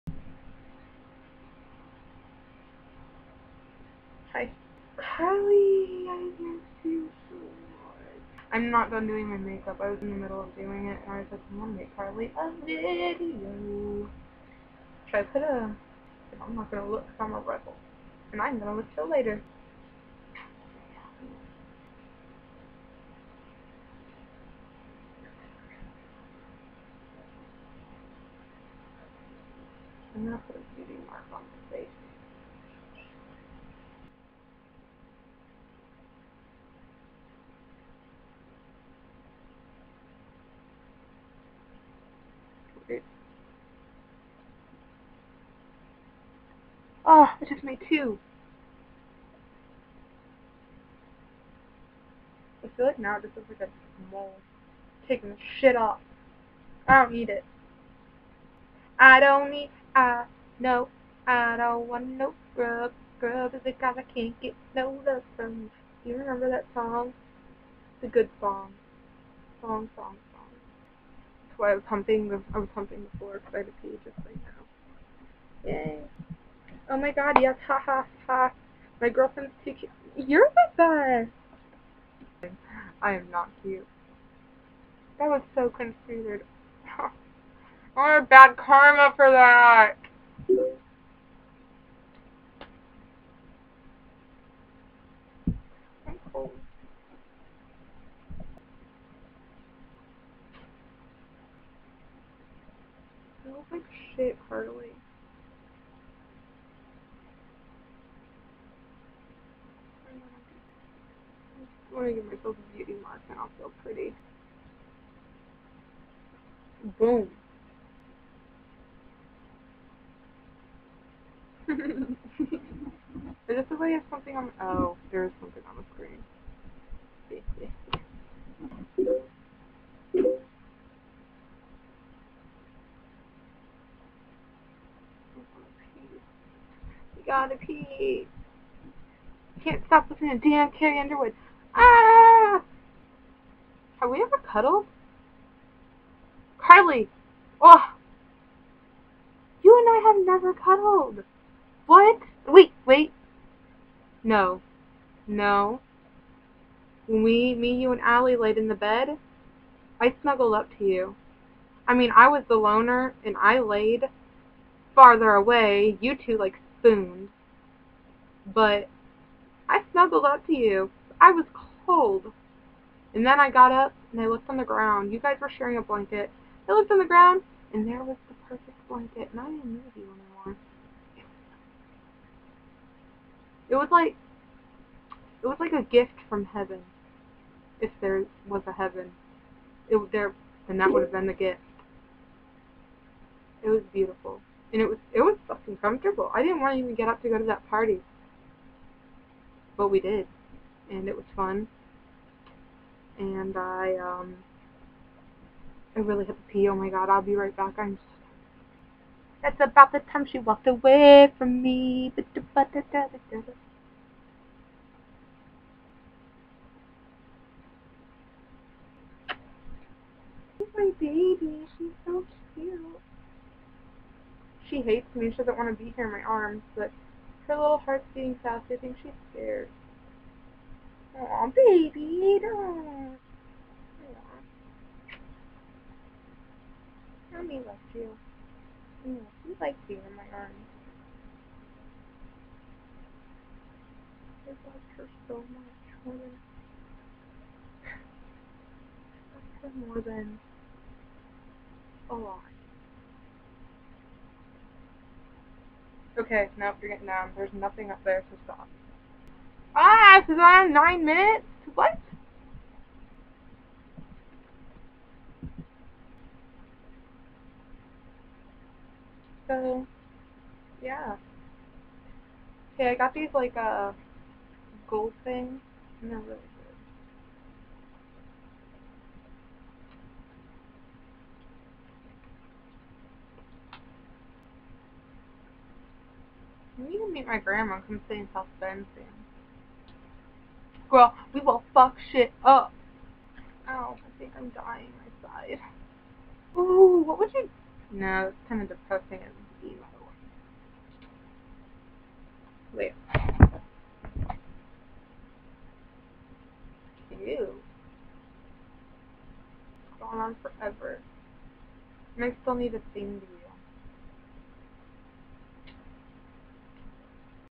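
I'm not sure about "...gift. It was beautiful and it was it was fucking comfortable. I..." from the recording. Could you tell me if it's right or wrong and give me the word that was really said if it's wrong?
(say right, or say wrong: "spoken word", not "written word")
right.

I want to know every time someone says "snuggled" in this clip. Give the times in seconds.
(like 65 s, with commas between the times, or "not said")
160 s, 169 s.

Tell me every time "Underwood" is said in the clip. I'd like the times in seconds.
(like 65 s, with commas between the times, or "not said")
140 s.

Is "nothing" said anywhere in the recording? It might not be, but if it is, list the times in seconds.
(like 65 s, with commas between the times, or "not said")
257 s.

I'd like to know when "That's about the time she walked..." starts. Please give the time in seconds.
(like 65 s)
209 s.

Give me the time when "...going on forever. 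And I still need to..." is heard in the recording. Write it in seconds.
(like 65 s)
309 s.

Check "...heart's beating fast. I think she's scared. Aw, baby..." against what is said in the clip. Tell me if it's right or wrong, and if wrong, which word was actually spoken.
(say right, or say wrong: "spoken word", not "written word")
right.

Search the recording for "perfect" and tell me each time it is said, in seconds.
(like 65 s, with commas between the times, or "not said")
178 s.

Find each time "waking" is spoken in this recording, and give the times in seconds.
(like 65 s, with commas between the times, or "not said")
not said.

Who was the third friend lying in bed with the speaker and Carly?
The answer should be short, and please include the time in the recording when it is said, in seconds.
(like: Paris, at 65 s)
Allie, at 158 s.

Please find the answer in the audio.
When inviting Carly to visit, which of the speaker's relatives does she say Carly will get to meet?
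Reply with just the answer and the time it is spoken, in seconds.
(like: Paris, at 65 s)
Grandma, at 287 s.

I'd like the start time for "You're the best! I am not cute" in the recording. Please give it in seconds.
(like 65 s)
80 s.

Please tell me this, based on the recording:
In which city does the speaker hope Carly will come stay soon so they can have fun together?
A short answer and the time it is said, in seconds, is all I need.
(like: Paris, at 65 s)
South Bend, at 288 s.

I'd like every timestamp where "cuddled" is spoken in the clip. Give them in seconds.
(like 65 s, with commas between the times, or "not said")
144 s, 150 s.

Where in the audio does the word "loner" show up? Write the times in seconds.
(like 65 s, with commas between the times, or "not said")
162 s.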